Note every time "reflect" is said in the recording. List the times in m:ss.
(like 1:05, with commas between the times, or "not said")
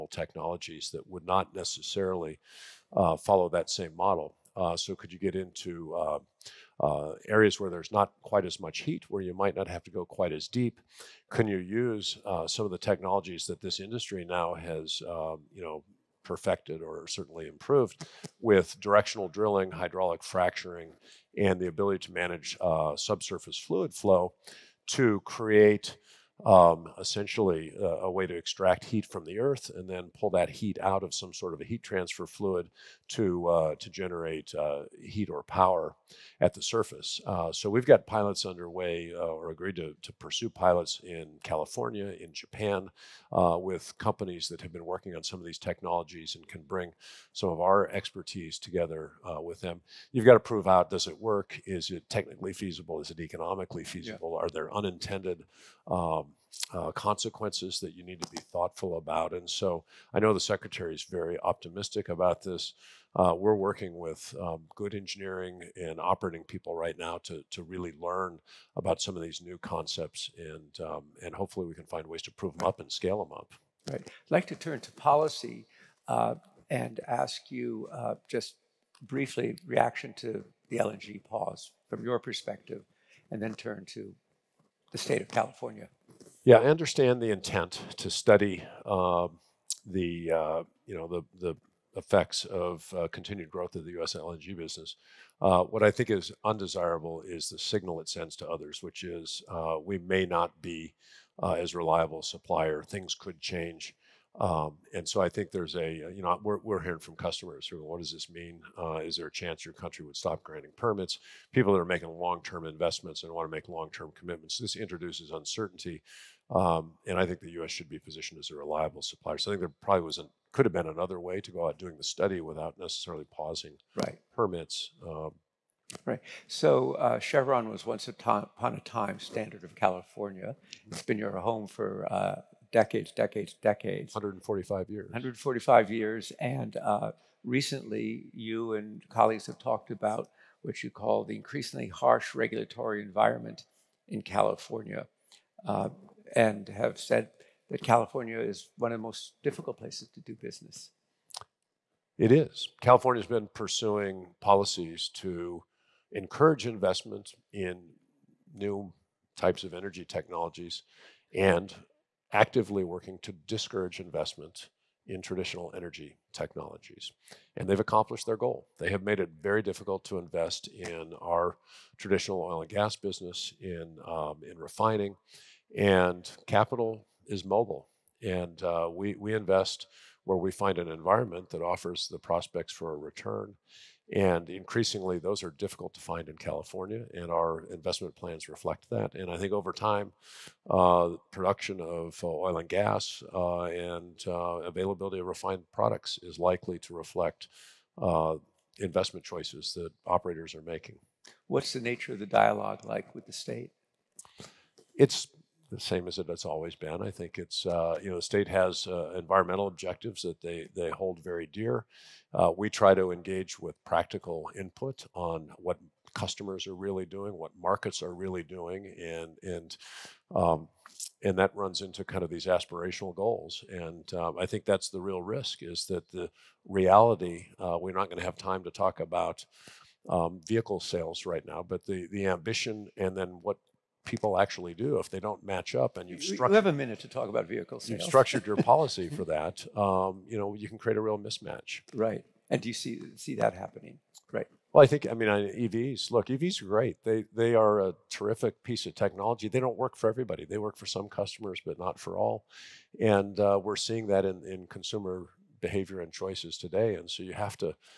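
3:08, 3:16.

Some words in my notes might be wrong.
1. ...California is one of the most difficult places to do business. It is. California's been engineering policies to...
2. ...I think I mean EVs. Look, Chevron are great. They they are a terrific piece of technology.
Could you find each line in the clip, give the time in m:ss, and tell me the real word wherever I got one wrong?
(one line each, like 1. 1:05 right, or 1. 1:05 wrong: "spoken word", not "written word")
1. 2:27 wrong: "pursuing", not "engineering"
2. 4:04 wrong: "EVs", not "Chevron".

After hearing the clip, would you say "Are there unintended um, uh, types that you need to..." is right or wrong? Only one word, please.
wrong.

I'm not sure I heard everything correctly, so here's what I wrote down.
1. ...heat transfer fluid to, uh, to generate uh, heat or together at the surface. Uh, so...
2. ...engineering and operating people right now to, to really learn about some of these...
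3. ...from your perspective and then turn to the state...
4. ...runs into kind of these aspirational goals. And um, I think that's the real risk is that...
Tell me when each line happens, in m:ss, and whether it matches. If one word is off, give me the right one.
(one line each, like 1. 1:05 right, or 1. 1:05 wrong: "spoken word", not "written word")
1. 0:31 wrong: "power", not "together"
2. 1:04 right
3. 1:21 right
4. 3:41 right.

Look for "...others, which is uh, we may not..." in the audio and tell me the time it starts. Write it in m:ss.
1:38.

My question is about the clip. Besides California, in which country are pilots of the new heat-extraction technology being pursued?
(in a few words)
Japan.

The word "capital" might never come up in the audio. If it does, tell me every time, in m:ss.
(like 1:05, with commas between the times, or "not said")
2:56.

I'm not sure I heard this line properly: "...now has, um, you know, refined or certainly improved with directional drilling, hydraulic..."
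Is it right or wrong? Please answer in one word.
wrong.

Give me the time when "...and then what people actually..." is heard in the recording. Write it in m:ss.
3:52.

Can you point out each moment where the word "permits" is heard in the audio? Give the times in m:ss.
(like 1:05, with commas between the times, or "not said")
1:50, 2:04.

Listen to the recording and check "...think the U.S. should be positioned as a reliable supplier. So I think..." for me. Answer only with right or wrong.
right.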